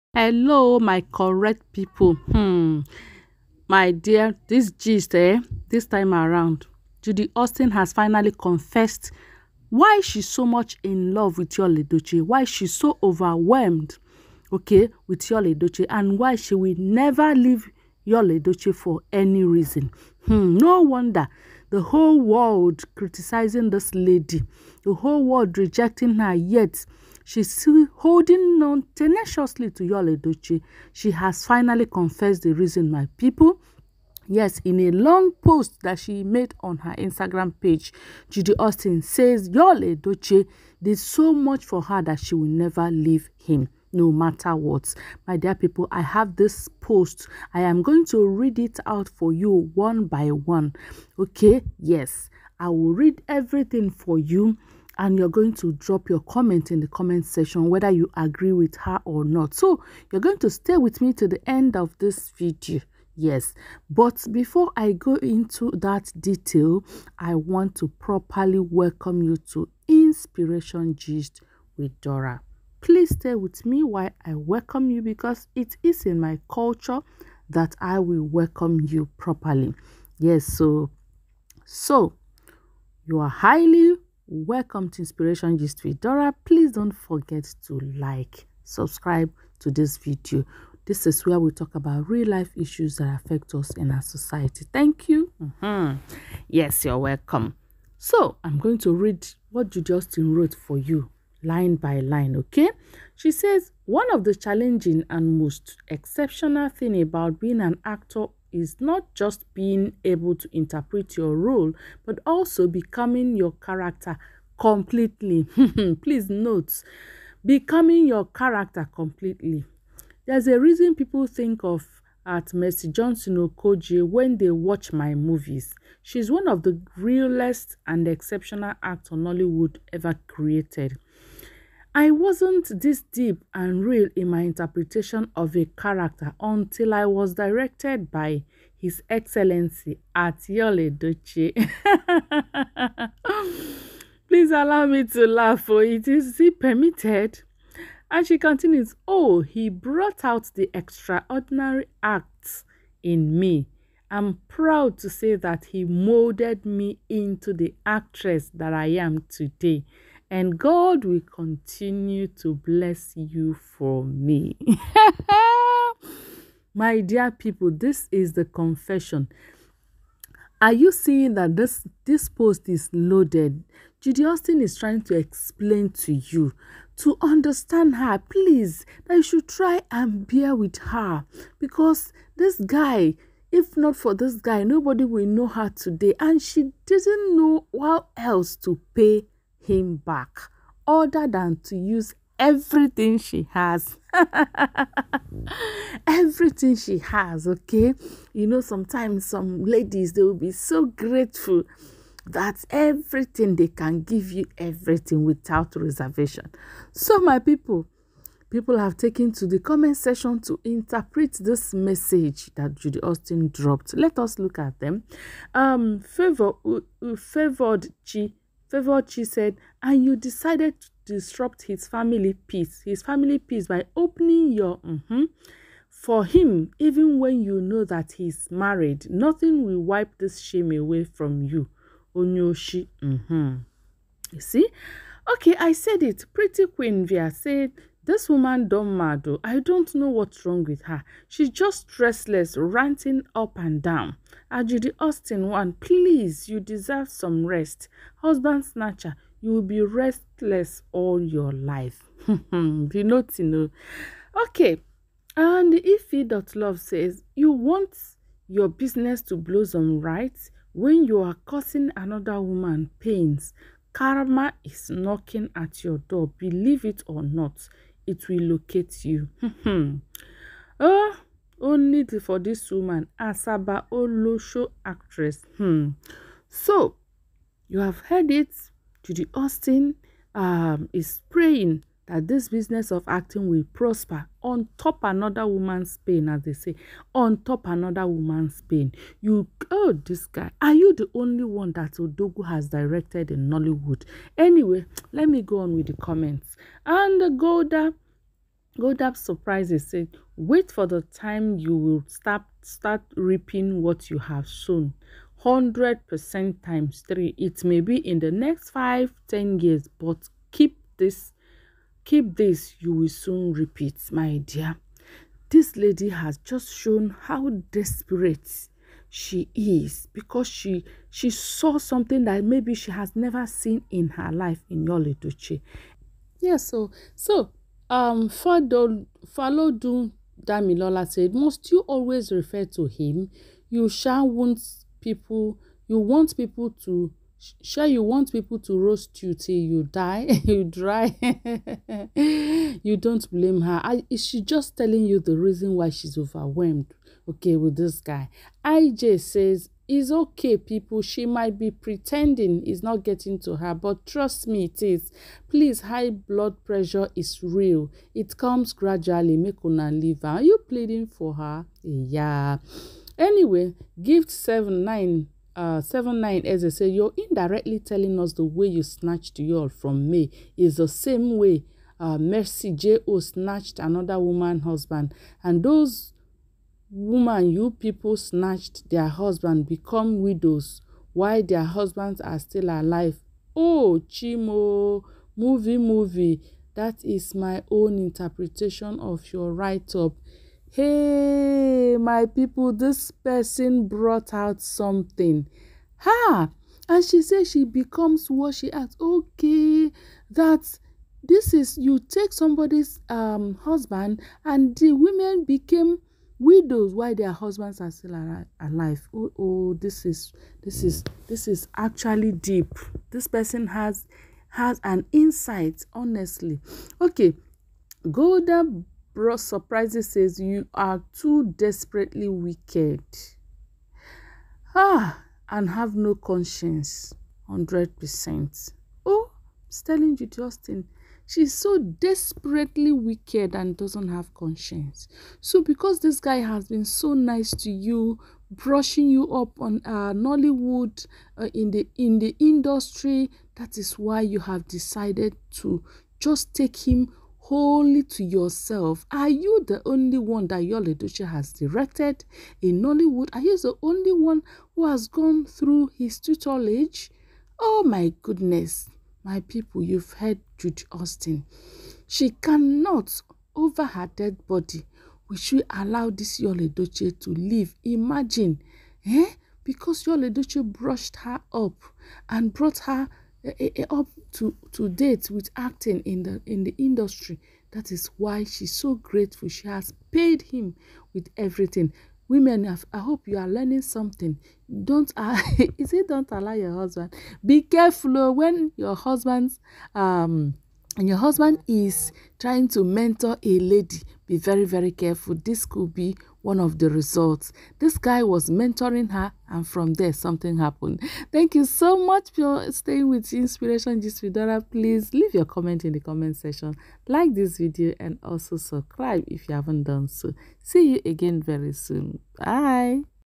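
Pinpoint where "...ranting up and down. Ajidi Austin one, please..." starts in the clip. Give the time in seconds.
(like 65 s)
242 s.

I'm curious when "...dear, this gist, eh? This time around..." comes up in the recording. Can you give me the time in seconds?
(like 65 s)
3 s.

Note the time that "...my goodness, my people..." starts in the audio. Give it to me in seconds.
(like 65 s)
457 s.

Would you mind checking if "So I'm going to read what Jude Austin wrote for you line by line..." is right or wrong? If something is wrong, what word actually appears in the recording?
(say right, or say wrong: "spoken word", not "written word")
right.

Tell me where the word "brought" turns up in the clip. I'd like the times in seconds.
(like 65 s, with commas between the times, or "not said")
149 s, 393 s, 419 s, 472 s.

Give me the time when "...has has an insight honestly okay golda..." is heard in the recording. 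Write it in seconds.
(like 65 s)
413 s.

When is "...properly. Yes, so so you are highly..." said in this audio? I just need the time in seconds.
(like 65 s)
79 s.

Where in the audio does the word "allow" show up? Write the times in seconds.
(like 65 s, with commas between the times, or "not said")
144 s, 465 s, 486 s.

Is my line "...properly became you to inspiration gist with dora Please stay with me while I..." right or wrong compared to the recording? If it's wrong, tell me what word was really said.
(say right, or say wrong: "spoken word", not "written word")
wrong: "welcome", not "became".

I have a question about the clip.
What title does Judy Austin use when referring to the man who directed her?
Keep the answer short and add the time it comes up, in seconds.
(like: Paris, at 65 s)
His Excellency, at 138 s.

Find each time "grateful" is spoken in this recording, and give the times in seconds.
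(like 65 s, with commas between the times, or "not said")
200 s, 478 s.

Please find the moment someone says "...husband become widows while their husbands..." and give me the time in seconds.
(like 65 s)
379 s.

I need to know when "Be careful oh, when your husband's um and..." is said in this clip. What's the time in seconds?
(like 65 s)
487 s.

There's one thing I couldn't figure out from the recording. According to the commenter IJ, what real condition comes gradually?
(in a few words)
High blood pressure.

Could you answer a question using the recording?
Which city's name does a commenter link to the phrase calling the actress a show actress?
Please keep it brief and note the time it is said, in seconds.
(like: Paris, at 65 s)
Asaba, at 273 s.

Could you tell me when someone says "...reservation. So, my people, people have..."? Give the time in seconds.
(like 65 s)
205 s.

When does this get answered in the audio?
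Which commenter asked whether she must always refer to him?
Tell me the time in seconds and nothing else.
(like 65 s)
330 s.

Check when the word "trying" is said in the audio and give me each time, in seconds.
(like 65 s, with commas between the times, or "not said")
174 s, 492 s.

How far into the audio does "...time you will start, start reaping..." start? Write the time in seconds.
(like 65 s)
301 s.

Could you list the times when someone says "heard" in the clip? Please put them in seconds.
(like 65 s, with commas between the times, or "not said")
277 s, 460 s.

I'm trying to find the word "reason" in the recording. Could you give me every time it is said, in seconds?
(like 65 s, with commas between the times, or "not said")
19 s, 32 s, 120 s, 345 s.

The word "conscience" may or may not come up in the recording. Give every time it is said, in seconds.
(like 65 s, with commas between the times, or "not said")
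426 s, 434 s.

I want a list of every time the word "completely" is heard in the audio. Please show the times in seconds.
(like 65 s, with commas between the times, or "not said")
114 s, 118 s.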